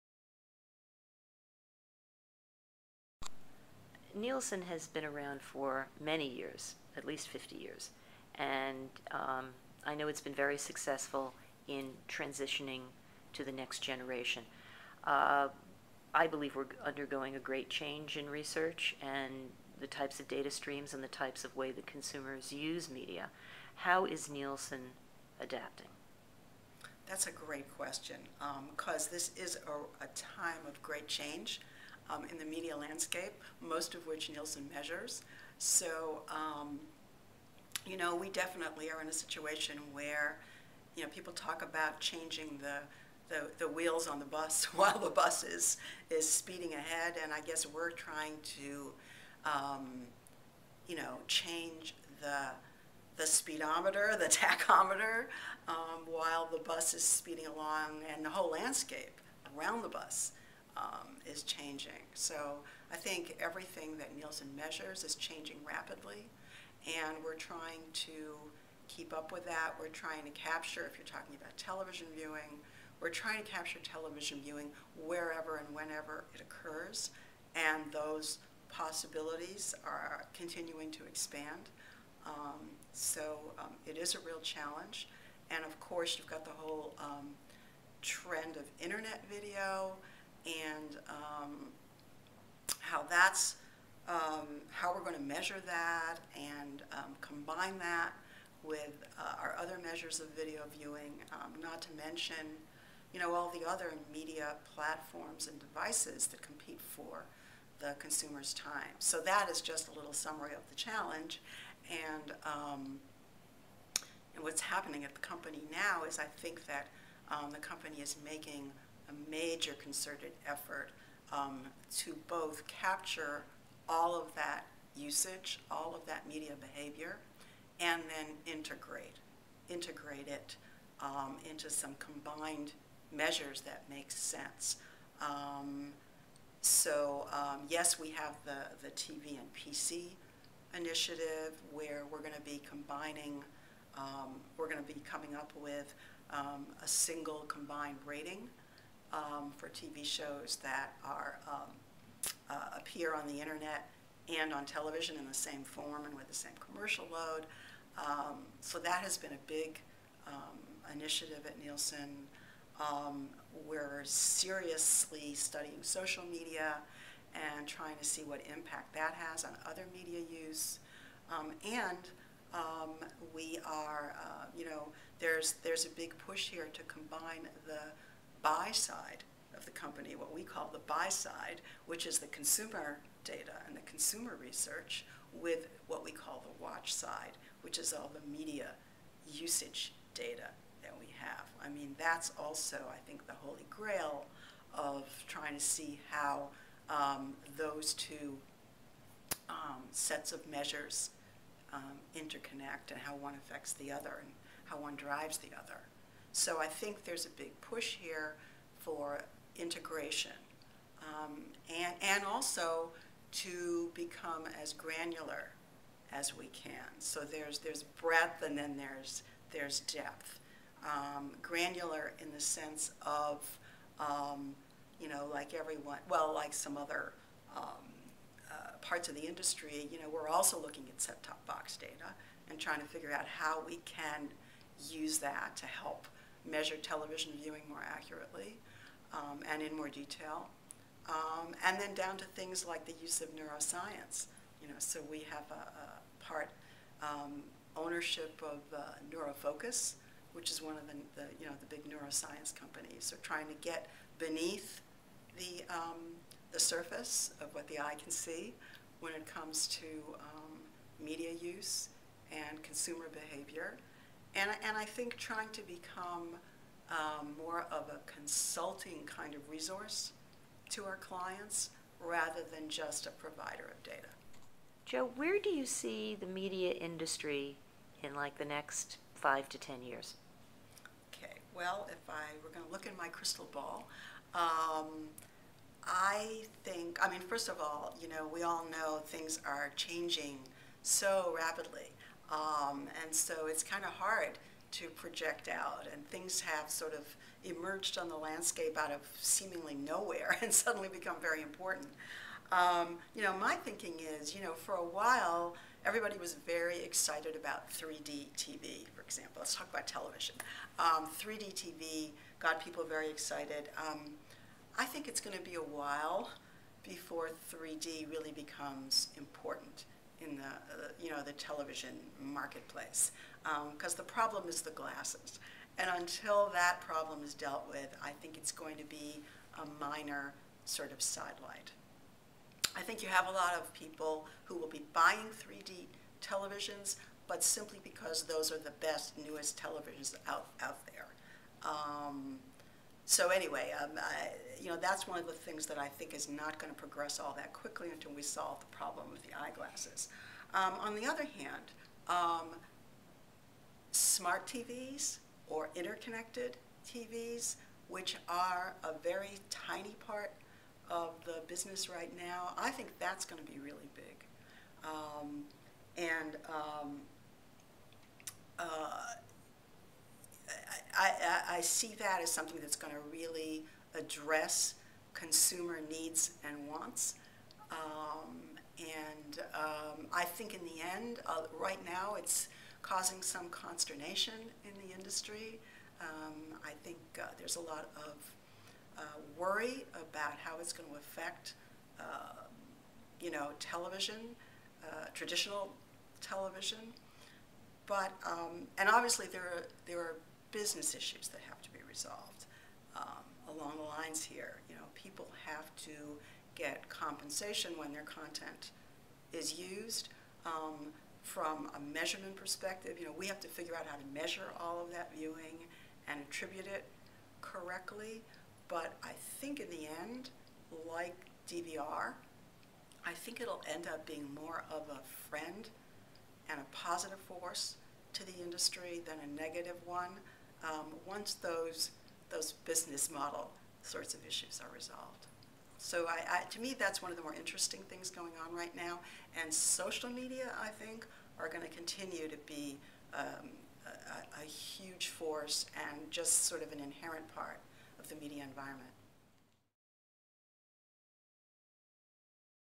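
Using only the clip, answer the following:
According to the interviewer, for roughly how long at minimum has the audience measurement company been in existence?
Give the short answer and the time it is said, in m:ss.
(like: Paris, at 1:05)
50 years, at 0:06.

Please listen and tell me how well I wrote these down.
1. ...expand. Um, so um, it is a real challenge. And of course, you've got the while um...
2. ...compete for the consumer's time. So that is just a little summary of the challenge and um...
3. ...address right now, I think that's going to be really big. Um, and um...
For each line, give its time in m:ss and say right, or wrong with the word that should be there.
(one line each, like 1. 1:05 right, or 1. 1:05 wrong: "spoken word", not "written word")
1. 1:21 wrong: "whole", not "while"
2. 1:46 right
3. 6:01 wrong: "business", not "address".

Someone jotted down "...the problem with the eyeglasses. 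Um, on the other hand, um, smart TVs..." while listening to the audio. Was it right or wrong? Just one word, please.
right.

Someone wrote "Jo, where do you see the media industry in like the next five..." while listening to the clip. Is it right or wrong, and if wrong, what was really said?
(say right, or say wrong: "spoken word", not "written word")
right.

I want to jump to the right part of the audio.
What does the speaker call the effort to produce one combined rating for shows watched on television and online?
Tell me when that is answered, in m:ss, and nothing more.
2:18.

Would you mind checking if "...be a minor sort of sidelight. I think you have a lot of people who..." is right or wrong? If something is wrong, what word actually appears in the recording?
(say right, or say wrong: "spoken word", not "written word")
right.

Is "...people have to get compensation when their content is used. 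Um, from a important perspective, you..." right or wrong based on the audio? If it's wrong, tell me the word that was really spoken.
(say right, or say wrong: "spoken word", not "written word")
wrong: "measurement", not "important".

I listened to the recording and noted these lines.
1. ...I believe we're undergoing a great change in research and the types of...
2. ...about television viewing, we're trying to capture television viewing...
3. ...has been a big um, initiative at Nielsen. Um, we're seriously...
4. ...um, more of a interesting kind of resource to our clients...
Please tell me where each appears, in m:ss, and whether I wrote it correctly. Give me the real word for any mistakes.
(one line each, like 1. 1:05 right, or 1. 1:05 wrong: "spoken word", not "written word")
1. 0:16 right
2. 1:11 right
3. 2:39 right
4. 4:26 wrong: "consulting", not "interesting".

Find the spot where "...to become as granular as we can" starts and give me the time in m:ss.
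3:33.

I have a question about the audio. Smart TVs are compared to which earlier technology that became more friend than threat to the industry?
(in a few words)
DVR.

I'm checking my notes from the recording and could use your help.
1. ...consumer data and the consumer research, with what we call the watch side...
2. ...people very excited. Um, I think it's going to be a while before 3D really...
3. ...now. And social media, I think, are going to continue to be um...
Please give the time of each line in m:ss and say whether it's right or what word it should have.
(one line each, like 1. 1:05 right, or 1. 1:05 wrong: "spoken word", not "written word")
1. 3:02 right
2. 5:12 right
3. 7:18 right.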